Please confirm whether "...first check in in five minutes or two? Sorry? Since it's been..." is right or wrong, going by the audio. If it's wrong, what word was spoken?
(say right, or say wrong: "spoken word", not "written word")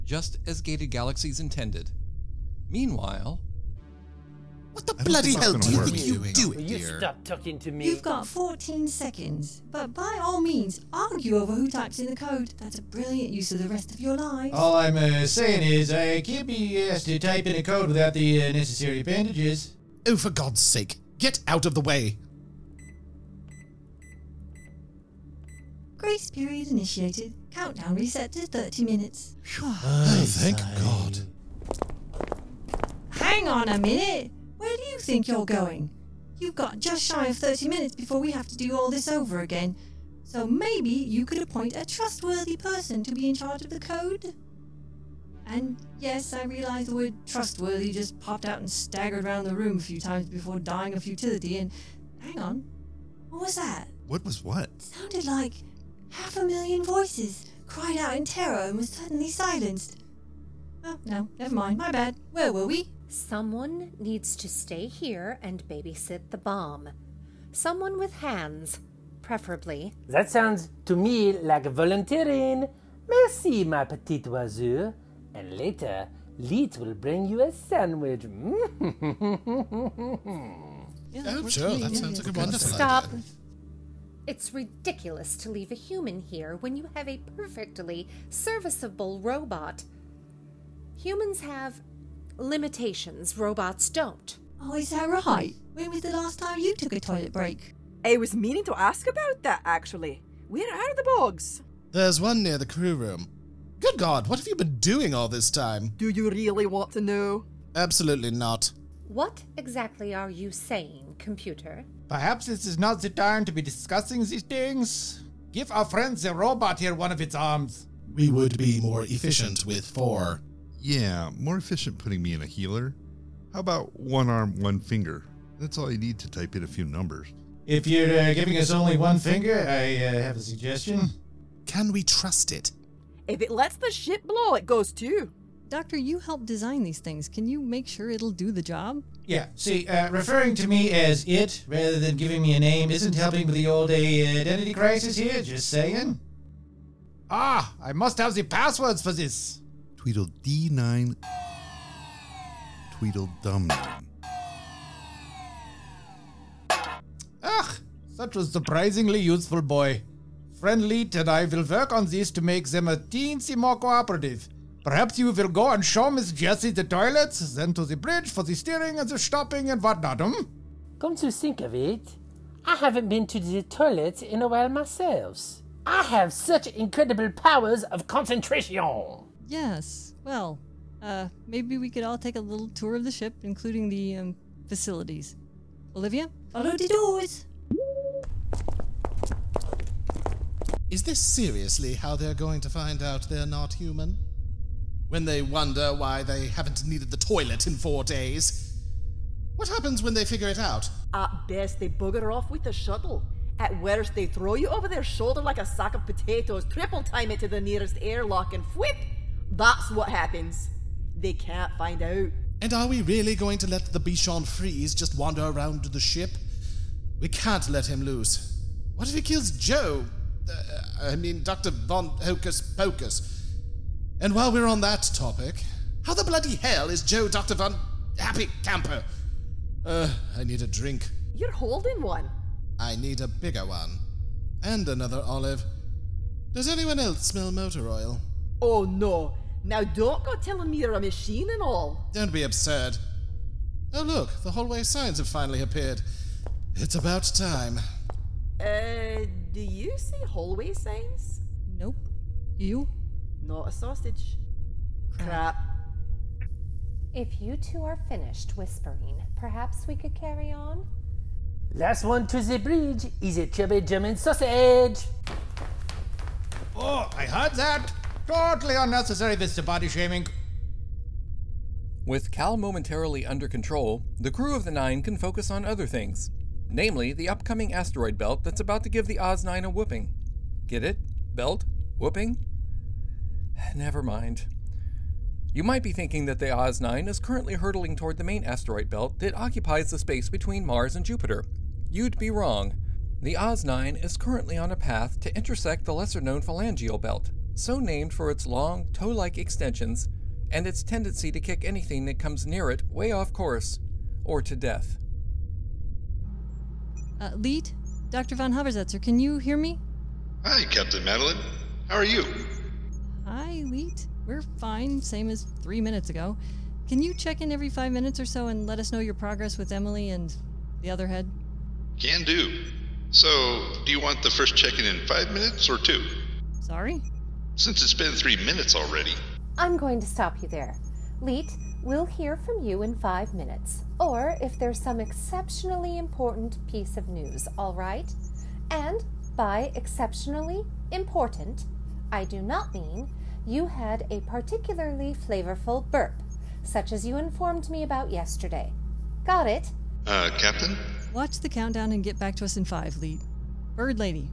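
right.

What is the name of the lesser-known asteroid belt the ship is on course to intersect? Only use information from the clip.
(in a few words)
phalangeal belt.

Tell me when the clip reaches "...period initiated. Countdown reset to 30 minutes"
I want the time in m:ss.
0:26.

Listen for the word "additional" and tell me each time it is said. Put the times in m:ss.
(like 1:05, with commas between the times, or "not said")
not said.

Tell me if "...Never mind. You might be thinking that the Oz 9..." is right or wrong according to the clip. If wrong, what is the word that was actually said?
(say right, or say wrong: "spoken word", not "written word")
right.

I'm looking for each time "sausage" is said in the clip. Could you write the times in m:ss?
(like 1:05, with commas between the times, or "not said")
4:13, 4:24.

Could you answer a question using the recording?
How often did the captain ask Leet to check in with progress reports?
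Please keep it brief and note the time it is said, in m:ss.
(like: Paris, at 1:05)
every 5 minutes, at 5:17.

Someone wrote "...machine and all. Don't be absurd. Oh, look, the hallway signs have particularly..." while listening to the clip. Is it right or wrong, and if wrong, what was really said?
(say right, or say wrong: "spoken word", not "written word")
wrong: "finally", not "particularly".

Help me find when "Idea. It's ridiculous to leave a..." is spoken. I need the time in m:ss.
1:23.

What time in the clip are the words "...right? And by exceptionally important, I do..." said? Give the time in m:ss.
5:37.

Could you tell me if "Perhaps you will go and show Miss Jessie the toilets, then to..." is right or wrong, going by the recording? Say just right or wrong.
right.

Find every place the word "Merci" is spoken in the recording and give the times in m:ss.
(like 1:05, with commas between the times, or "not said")
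1:13.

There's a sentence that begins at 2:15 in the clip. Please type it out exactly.
Doctor, you helped design these things.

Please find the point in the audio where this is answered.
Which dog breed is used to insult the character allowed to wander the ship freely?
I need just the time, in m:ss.
3:33.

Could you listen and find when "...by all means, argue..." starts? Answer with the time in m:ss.
0:09.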